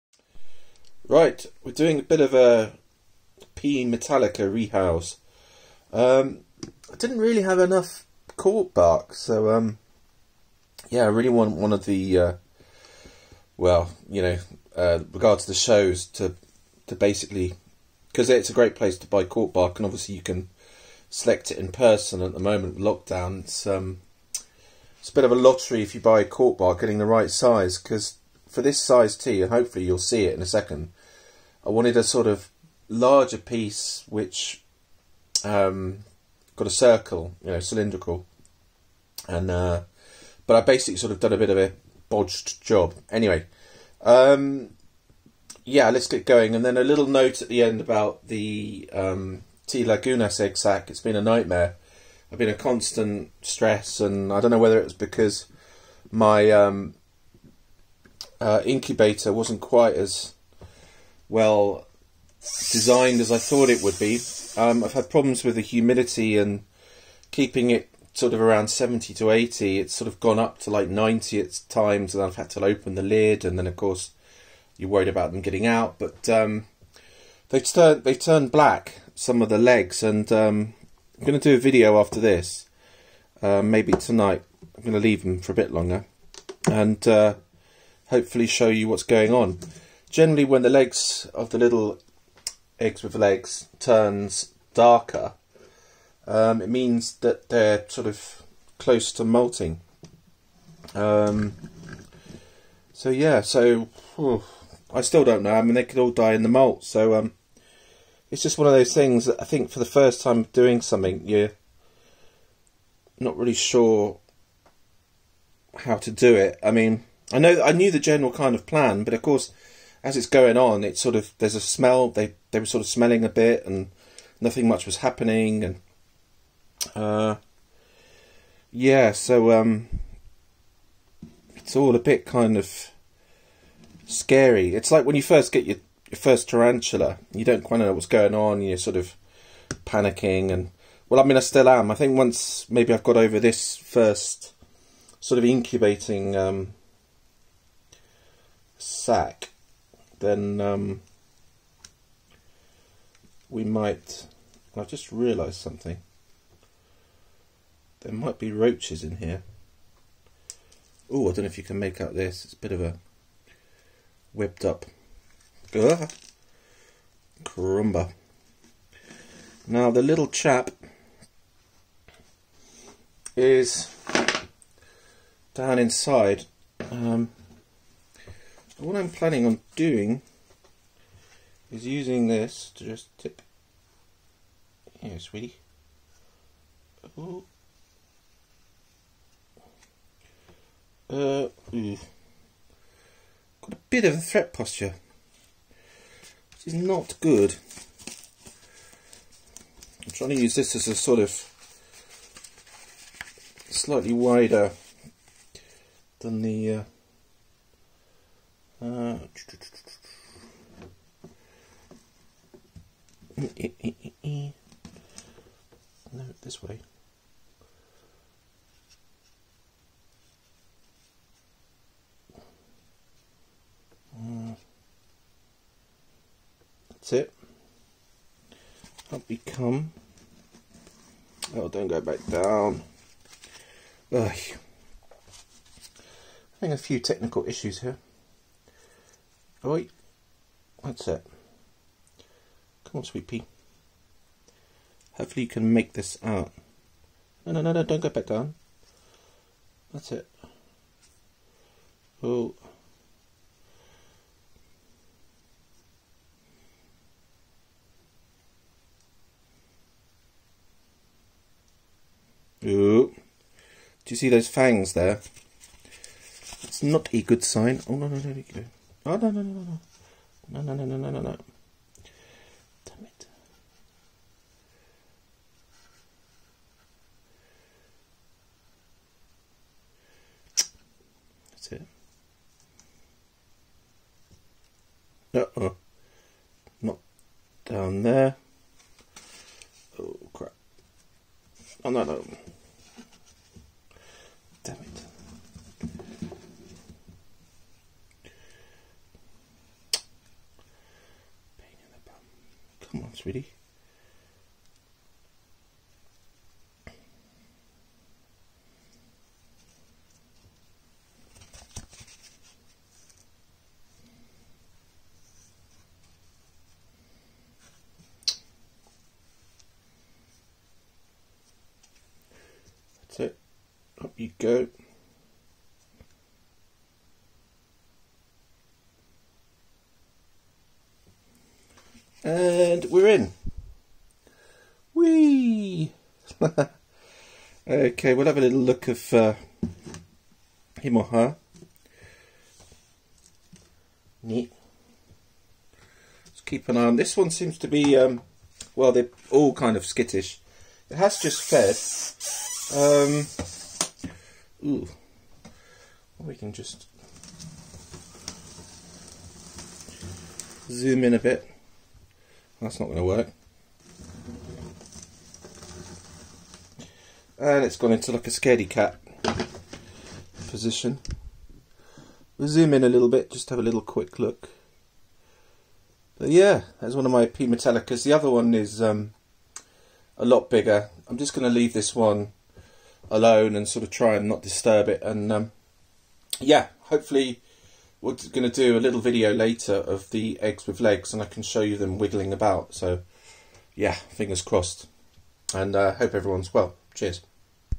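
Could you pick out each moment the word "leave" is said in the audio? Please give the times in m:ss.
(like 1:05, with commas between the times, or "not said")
1:25, 6:21.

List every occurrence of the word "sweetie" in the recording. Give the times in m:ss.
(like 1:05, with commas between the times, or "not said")
3:05, 4:03, 5:03.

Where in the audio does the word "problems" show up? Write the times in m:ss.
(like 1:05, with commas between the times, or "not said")
1:05.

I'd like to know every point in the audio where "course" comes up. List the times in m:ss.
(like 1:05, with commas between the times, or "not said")
1:13, 1:59.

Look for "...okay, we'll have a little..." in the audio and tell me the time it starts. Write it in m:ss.
5:37.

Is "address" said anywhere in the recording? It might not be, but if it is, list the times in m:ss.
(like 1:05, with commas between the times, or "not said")
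not said.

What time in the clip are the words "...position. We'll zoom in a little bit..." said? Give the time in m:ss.
6:10.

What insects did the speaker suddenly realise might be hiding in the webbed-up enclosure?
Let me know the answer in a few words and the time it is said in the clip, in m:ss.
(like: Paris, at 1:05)
Roaches, at 2:38.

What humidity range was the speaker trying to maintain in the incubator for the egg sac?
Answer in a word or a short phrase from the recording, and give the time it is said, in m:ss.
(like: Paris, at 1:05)
70 to 80, at 1:08.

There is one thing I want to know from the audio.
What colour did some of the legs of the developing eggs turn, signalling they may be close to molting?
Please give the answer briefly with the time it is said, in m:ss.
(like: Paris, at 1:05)
Black, at 1:18.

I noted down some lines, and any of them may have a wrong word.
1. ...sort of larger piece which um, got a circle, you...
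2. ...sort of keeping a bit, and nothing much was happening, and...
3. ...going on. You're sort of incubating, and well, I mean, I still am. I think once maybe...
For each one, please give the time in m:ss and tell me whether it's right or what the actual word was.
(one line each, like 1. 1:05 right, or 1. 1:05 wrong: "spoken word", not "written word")
1. 0:32 right
2. 2:02 wrong: "smelling", not "keeping"
3. 2:18 wrong: "panicking", not "incubating".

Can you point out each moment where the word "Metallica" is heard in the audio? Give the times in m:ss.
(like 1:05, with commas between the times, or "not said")
0:03, 6:17.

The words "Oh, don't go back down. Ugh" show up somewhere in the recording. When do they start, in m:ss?
3:51.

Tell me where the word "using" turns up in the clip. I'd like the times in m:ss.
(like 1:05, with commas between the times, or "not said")
3:01.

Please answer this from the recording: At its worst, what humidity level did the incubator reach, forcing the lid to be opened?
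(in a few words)
90.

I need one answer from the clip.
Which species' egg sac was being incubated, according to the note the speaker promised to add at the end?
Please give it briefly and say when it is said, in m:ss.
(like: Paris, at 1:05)
T Lagunas, at 0:49.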